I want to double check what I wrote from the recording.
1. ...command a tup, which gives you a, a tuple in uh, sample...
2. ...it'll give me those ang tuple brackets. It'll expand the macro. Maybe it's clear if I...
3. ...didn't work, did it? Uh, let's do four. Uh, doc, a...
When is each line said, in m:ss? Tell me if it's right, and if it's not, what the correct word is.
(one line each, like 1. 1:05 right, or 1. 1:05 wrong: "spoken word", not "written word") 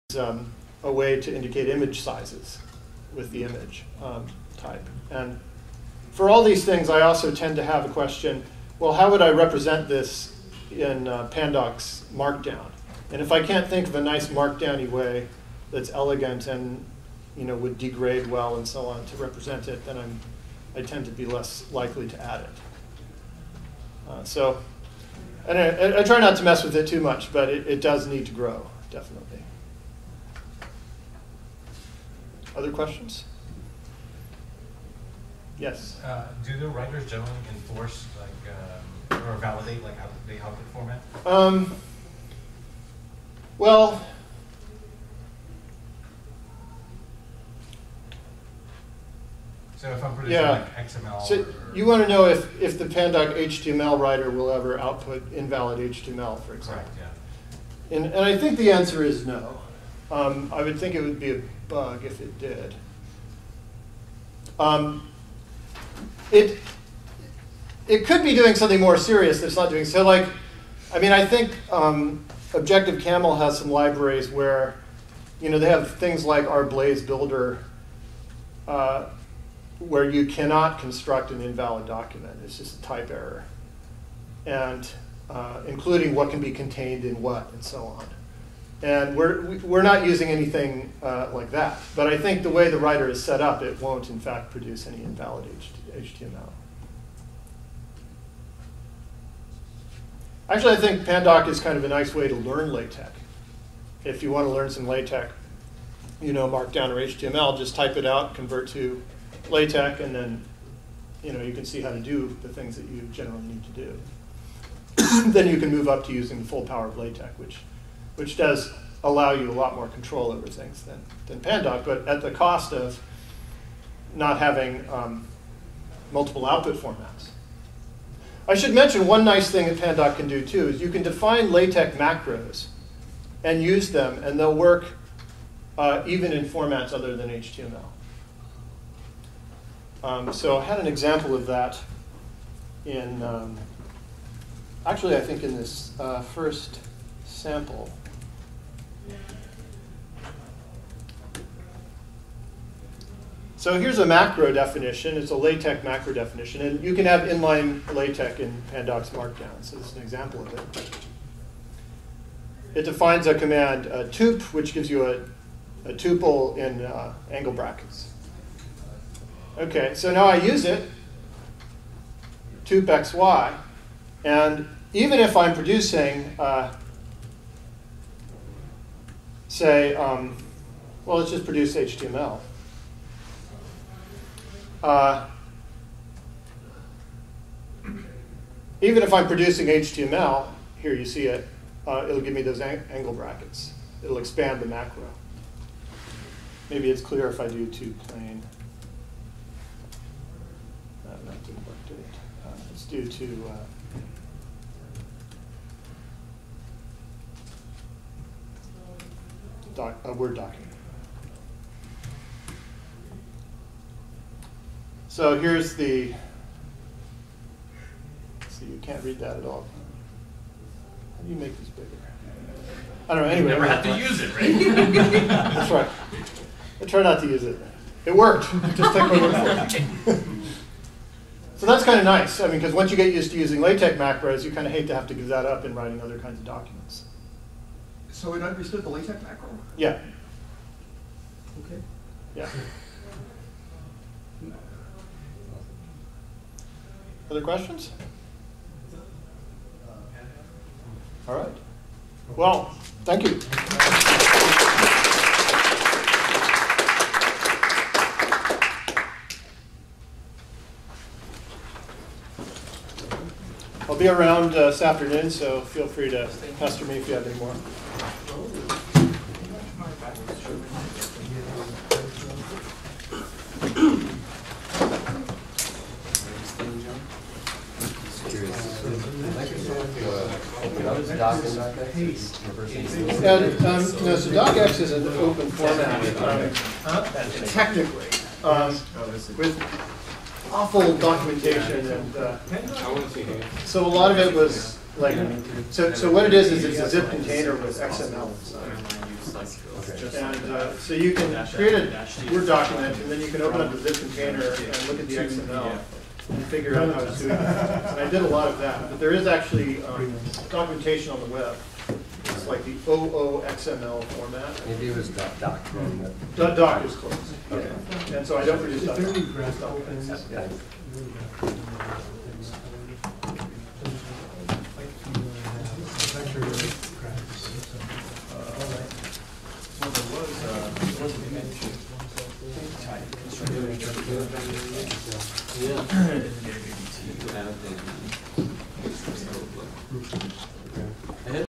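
1. 2:43 wrong: "angle", not "sample"
2. 3:12 wrong: "angle", not "tuple"
3. 3:21 wrong: "two", not "four".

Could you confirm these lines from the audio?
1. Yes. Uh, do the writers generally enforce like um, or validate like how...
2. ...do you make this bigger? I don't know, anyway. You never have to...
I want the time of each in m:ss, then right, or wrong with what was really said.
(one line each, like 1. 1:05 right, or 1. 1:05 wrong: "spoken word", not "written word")
1. 0:35 right
2. 3:41 right.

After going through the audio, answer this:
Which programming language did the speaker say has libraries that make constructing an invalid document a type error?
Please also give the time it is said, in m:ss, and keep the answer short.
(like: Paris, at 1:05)
Objective Caml, at 1:12.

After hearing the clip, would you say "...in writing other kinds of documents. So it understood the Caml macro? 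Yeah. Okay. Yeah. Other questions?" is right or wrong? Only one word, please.
wrong.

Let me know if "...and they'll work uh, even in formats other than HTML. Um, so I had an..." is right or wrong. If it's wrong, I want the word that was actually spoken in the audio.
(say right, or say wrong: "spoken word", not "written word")
right.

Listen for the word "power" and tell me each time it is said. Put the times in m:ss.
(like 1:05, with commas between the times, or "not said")
1:56.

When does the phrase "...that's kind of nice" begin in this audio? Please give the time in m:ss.
3:51.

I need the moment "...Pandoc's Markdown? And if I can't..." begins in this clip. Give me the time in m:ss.
0:11.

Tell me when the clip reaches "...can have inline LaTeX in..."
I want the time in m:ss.
2:36.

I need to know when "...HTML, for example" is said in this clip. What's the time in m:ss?
0:55.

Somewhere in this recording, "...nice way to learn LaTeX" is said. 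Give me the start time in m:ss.
1:41.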